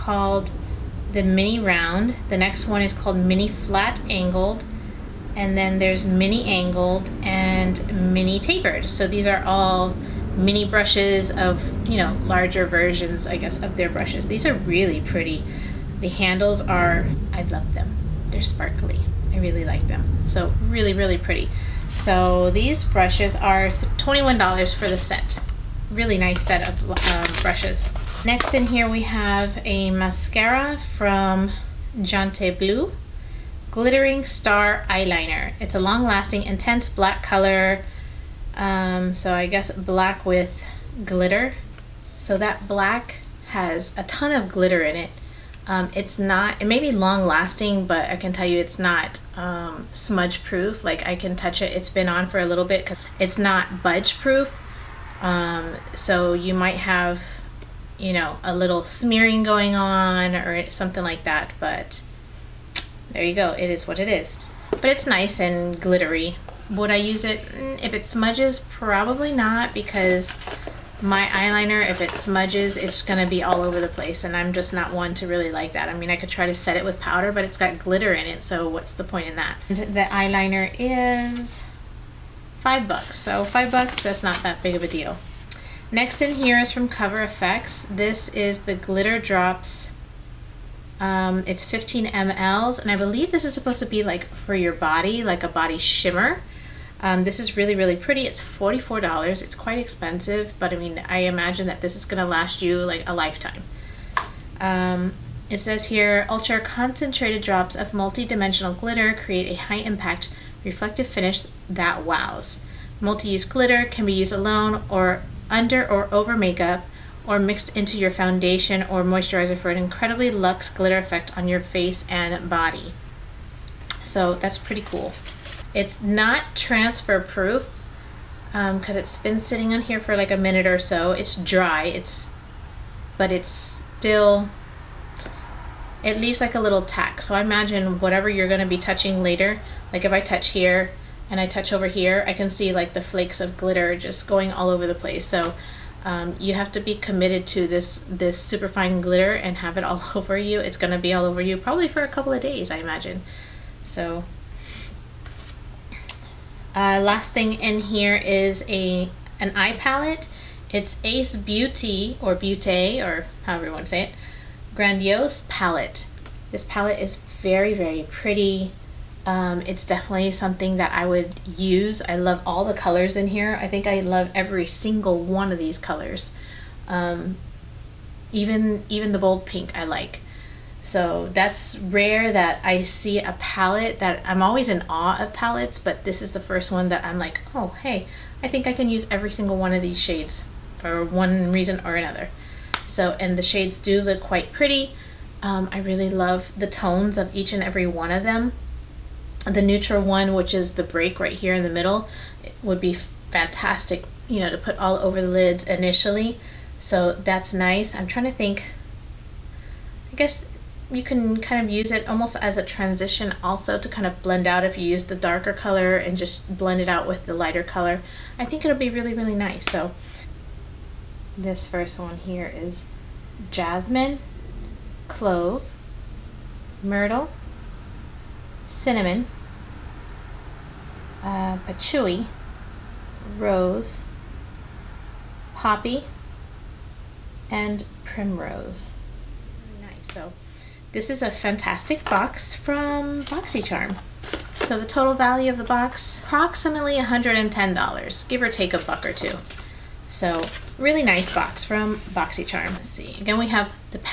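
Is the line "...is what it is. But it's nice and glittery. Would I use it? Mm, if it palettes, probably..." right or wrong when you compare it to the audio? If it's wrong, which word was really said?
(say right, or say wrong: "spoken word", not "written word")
wrong: "smudges", not "palettes".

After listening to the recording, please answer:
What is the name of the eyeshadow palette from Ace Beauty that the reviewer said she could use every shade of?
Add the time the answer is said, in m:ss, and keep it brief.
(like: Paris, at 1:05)
Grandiose Palette, at 2:44.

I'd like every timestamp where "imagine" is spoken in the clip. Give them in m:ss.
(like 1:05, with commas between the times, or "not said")
1:41, 2:17, 2:32.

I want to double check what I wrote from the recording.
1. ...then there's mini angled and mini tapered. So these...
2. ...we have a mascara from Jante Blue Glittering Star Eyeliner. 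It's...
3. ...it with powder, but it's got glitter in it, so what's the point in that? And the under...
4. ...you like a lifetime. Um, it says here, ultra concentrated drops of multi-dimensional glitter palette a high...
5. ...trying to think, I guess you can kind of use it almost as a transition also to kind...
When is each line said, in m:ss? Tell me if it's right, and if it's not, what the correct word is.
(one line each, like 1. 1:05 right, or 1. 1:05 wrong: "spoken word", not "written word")
1. 0:05 right
2. 0:28 right
3. 1:16 wrong: "eyeliner", not "under"
4. 1:42 wrong: "create", not "palette"
5. 3:28 right.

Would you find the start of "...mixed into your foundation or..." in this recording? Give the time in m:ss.
1:57.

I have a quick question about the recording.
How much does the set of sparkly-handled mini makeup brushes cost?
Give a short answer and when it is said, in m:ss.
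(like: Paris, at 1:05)
$21, at 0:23.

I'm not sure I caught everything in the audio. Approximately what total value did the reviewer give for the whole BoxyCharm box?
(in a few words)
$110.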